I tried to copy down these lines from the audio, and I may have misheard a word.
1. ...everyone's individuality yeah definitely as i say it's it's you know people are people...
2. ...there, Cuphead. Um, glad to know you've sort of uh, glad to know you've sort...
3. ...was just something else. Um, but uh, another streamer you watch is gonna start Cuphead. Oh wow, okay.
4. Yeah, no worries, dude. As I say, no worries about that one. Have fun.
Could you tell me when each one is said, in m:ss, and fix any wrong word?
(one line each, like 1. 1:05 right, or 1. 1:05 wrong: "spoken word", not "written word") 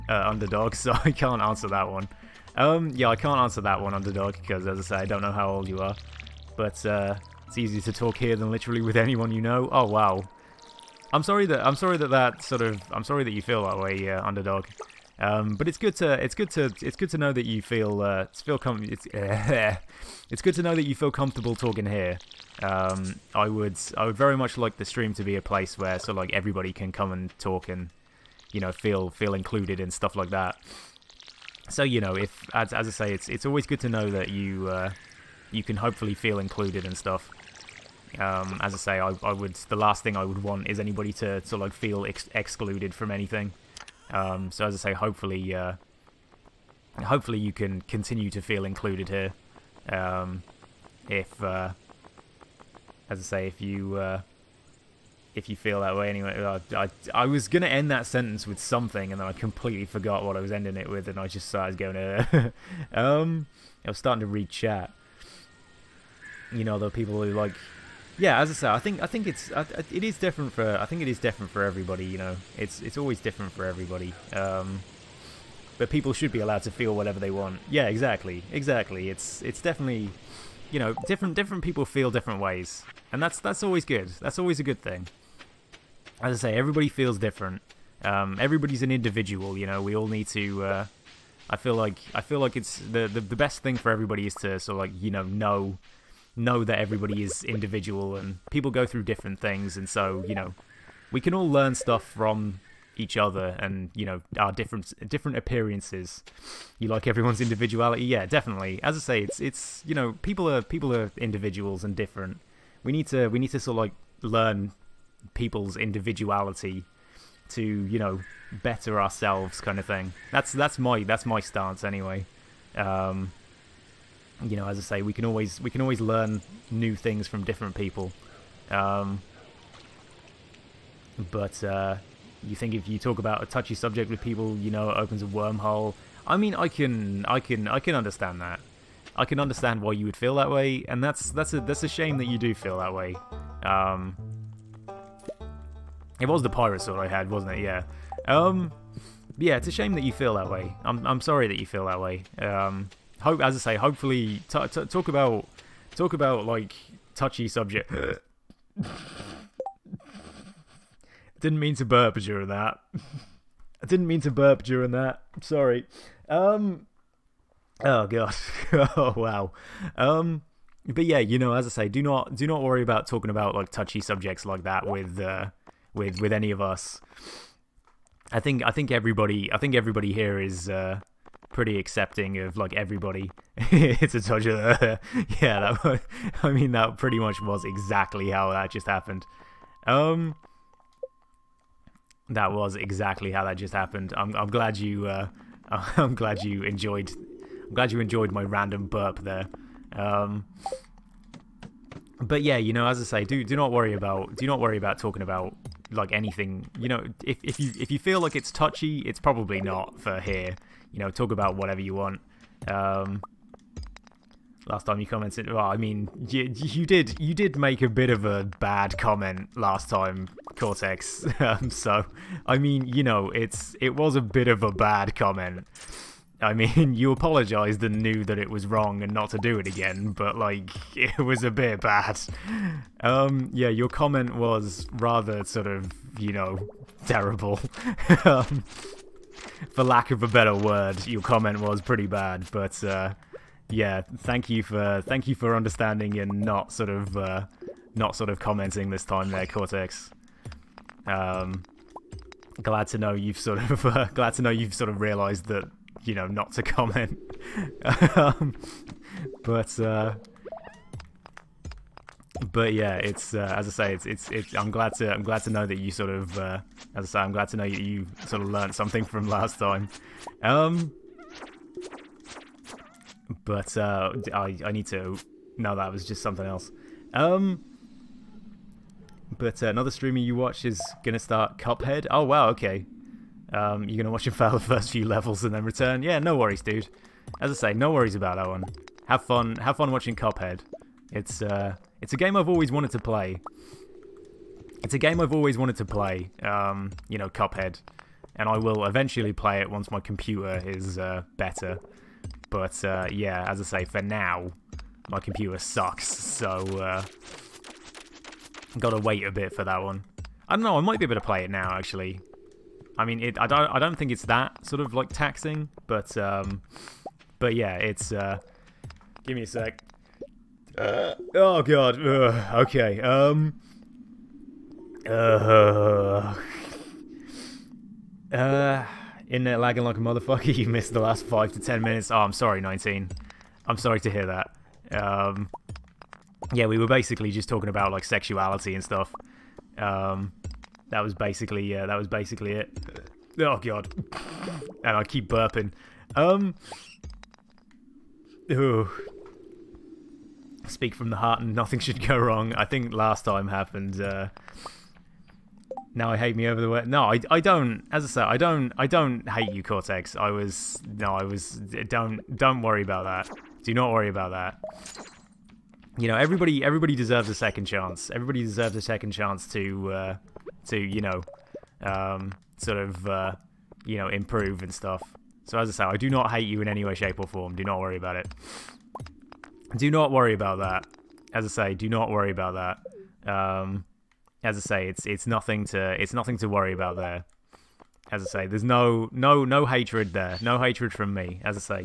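1. 1:47 right
2. 4:09 wrong: "Cortex", not "Cuphead"
3. 4:35 right
4. 4:46 right.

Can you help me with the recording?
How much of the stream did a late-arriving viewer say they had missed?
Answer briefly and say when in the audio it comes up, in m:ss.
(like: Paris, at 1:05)
5 to 10 minutes, at 5:31.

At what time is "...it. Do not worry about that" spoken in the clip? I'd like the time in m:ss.
6:18.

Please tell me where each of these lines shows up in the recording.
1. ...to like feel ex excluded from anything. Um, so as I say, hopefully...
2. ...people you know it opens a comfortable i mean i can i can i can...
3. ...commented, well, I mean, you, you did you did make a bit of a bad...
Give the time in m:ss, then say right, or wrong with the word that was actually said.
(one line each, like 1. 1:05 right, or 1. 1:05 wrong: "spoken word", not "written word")
1. 0:41 right
2. 2:14 wrong: "wormhole", not "comfortable"
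3. 3:35 right.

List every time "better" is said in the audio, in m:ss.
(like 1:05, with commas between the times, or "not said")
1:58, 4:00, 5:01.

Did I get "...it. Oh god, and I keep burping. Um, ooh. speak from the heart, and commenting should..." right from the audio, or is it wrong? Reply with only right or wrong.
wrong.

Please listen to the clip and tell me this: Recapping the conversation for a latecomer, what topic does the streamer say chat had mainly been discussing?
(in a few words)
sexuality.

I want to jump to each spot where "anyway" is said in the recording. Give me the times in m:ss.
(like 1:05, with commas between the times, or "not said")
0:56, 2:01.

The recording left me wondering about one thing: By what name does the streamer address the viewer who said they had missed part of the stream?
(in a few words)
19.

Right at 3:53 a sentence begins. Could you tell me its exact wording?
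Um, yeah, your comment was rather sort of, you know, terrible.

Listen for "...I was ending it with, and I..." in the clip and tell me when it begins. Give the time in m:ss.
1:00.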